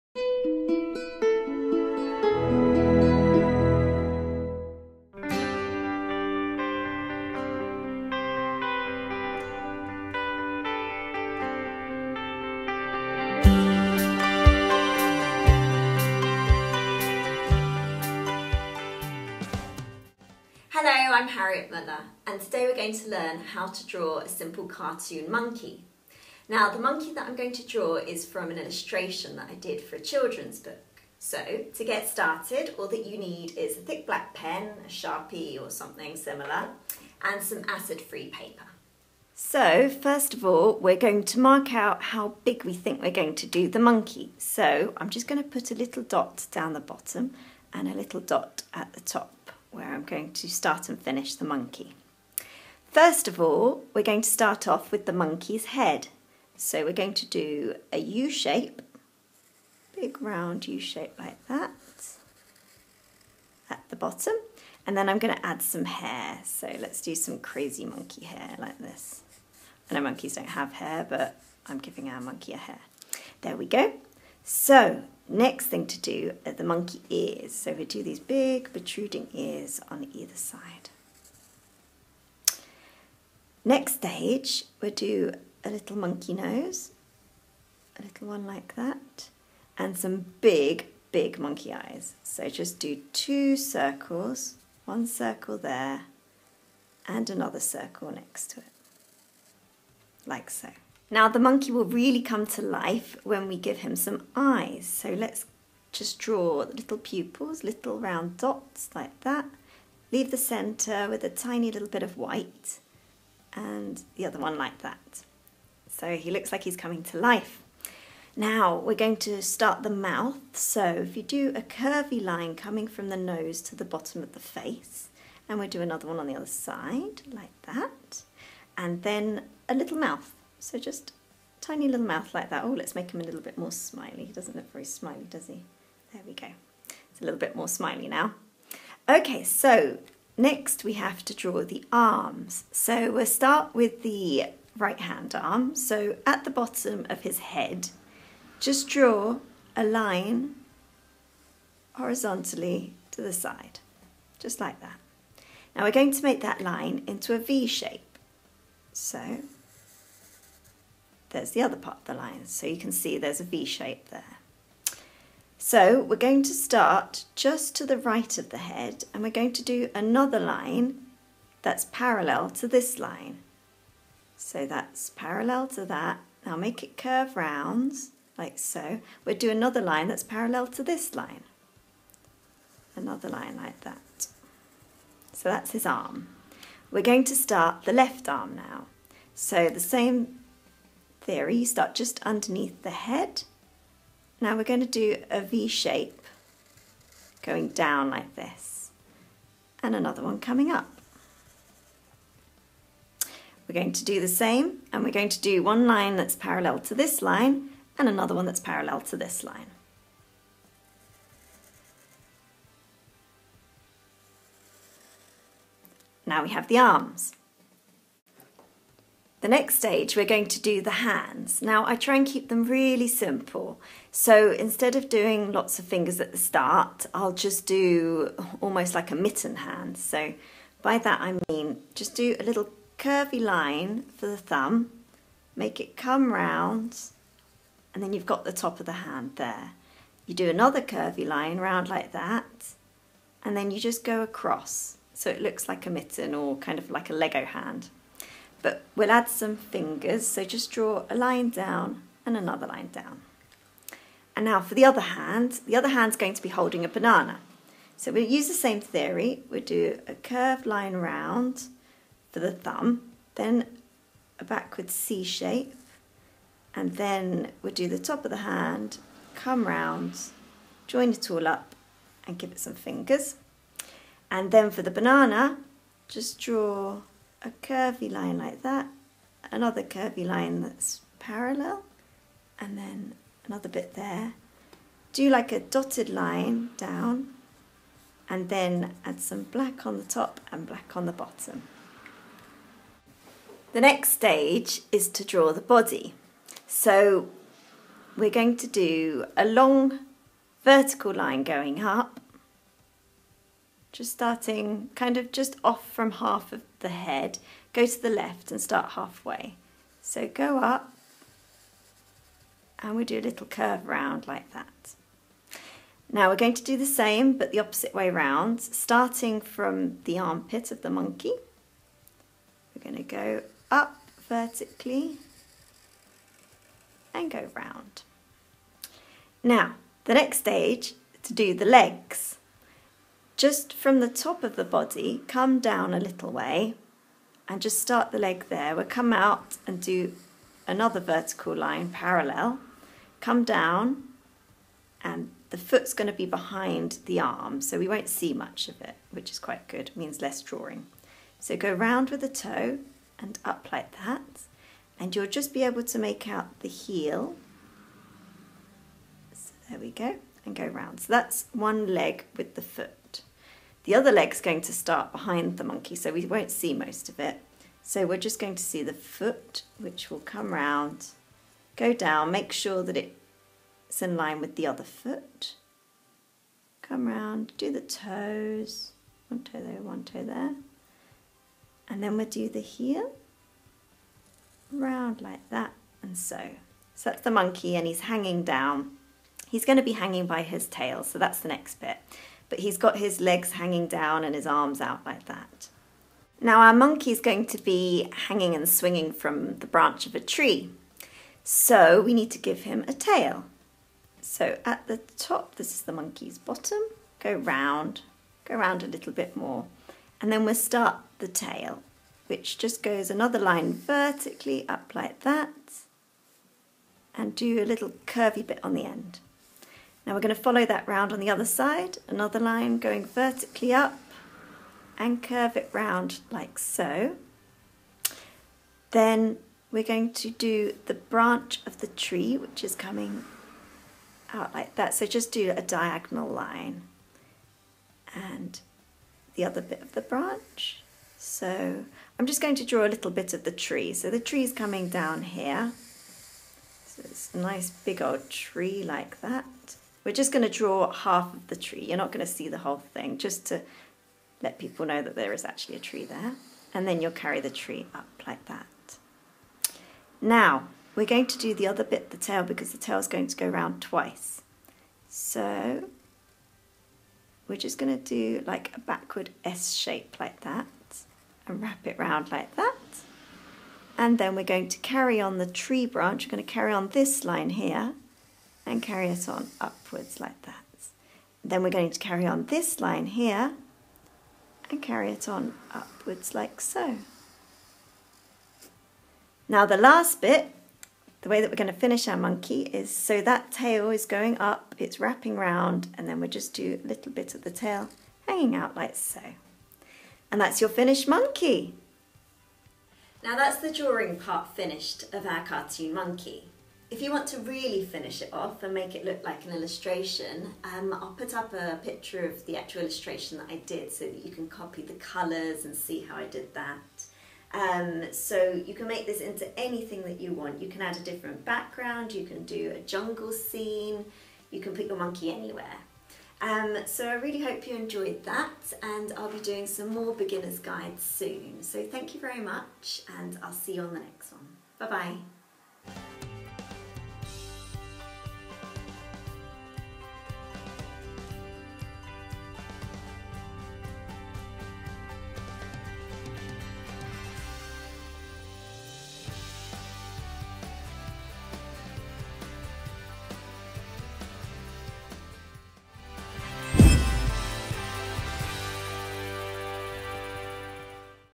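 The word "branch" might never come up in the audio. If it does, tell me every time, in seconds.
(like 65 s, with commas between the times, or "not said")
399 s, 430 s, 440 s, 475 s.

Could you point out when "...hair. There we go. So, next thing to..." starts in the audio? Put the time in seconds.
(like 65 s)
72 s.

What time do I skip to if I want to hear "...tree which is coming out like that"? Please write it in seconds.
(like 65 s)
431 s.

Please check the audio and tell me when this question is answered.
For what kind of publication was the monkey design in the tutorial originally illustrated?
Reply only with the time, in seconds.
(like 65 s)
29 s.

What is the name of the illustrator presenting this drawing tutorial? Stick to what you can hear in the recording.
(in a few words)
Harriet Muller.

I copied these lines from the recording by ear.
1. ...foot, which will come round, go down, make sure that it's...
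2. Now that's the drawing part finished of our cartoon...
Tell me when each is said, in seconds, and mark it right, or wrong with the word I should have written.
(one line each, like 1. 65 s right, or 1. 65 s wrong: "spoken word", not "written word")
1. 368 s right
2. 503 s right.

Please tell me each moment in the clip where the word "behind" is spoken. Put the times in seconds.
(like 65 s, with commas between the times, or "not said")
346 s, 365 s.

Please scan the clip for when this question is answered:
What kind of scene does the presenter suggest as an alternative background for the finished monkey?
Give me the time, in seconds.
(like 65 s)
522 s.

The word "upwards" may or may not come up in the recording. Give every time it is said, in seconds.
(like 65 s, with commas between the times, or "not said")
479 s, 485 s.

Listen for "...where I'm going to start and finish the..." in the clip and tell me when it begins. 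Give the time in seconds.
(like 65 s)
49 s.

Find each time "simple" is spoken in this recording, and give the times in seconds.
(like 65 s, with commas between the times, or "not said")
24 s, 223 s.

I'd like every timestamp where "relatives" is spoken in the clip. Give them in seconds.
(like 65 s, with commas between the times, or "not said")
not said.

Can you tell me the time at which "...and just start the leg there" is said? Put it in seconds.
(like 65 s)
337 s.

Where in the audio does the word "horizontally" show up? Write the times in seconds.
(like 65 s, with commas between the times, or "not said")
151 s.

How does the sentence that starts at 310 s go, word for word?
So go up and we do a little curve round like that.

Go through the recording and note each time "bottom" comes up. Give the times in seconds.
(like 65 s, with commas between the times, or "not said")
46 s, 63 s, 123 s, 146 s, 291 s, 406 s.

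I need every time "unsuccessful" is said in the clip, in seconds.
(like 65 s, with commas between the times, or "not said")
not said.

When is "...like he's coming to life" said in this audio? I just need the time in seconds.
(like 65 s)
116 s.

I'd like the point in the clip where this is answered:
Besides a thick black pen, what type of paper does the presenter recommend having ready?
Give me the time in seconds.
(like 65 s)
37 s.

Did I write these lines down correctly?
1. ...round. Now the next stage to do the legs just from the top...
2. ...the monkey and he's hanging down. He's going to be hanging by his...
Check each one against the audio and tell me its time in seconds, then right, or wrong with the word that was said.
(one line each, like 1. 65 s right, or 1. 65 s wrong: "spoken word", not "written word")
1. 327 s right
2. 387 s right.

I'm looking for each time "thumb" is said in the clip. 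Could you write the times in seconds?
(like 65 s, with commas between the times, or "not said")
234 s, 262 s.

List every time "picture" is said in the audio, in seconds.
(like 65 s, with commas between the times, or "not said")
511 s.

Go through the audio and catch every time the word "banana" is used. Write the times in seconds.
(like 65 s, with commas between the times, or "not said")
256 s, 274 s.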